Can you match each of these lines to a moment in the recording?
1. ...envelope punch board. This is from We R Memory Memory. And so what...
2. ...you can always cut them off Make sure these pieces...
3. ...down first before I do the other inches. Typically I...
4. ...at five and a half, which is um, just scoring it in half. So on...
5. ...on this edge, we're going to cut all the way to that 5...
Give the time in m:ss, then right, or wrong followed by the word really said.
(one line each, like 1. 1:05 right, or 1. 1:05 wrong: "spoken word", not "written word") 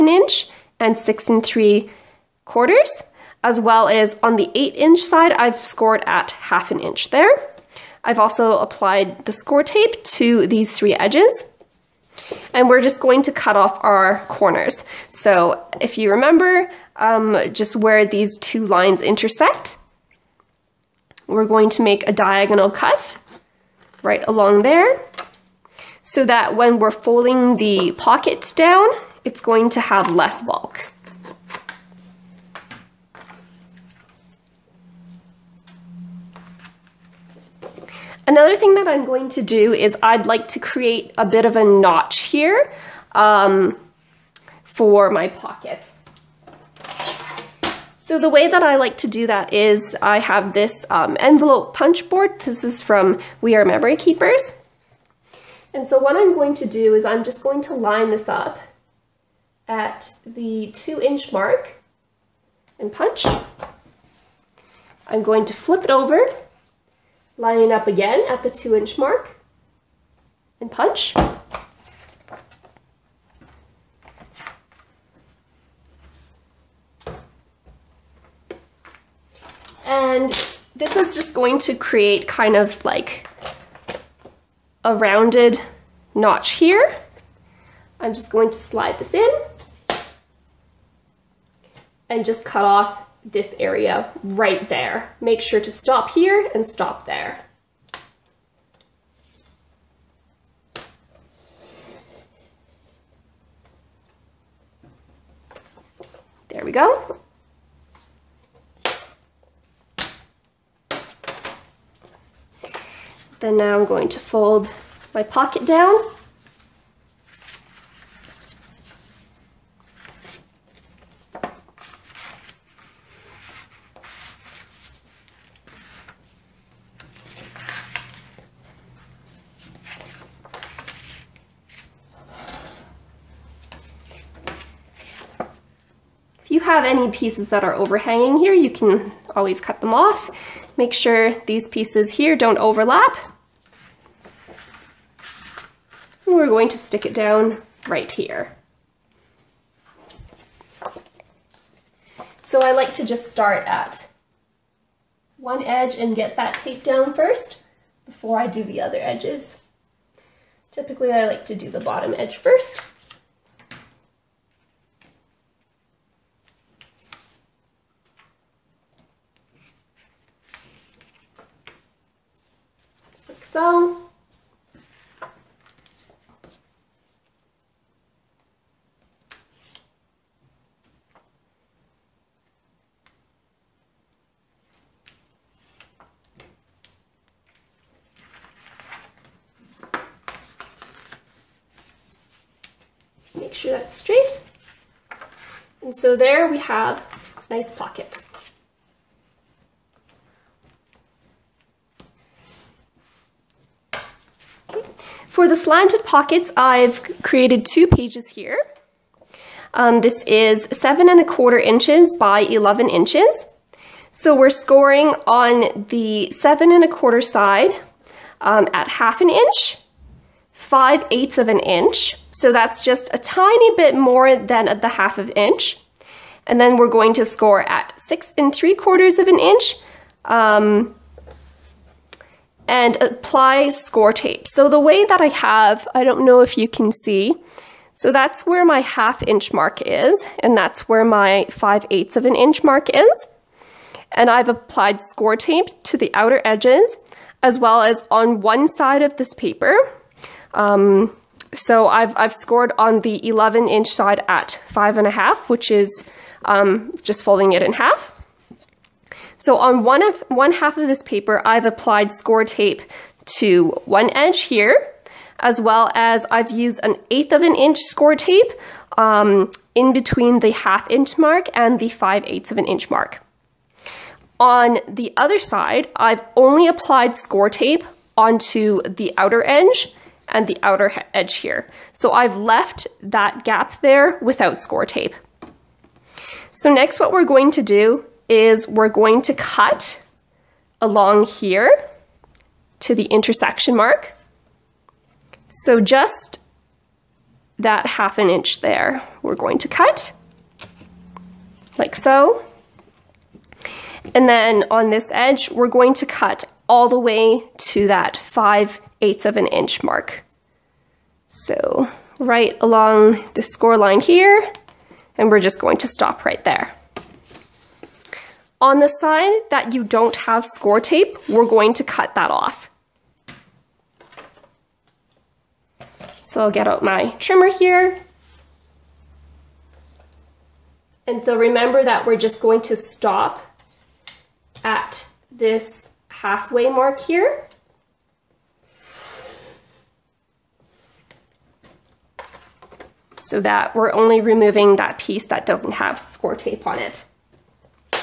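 1. 0:51 wrong: "Keepers", not "Memory"
2. 2:18 right
3. 2:36 wrong: "edges", not "inches"
4. 4:14 wrong: "folding", not "scoring"
5. 5:04 right.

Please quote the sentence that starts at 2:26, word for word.
And we're going to stick it down right here.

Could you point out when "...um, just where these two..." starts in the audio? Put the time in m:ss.
0:16.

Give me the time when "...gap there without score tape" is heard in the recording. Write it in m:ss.
4:43.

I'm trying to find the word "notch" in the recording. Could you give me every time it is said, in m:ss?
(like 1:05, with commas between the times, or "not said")
0:41, 1:26.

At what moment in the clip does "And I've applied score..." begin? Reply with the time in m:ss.
4:04.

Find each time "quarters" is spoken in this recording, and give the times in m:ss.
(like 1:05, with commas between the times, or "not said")
0:02, 3:31, 3:36, 3:48.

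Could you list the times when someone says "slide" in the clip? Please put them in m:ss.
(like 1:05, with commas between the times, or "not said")
1:28.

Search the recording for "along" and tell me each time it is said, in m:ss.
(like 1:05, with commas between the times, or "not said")
0:24, 4:50, 5:12.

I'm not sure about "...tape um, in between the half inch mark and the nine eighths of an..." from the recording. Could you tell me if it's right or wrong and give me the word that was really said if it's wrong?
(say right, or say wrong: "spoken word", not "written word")
wrong: "five", not "nine".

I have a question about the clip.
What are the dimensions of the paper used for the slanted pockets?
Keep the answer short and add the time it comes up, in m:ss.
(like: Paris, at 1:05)
7 1/4 by 11 inches, at 3:30.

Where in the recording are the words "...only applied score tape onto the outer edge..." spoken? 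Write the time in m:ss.
4:36.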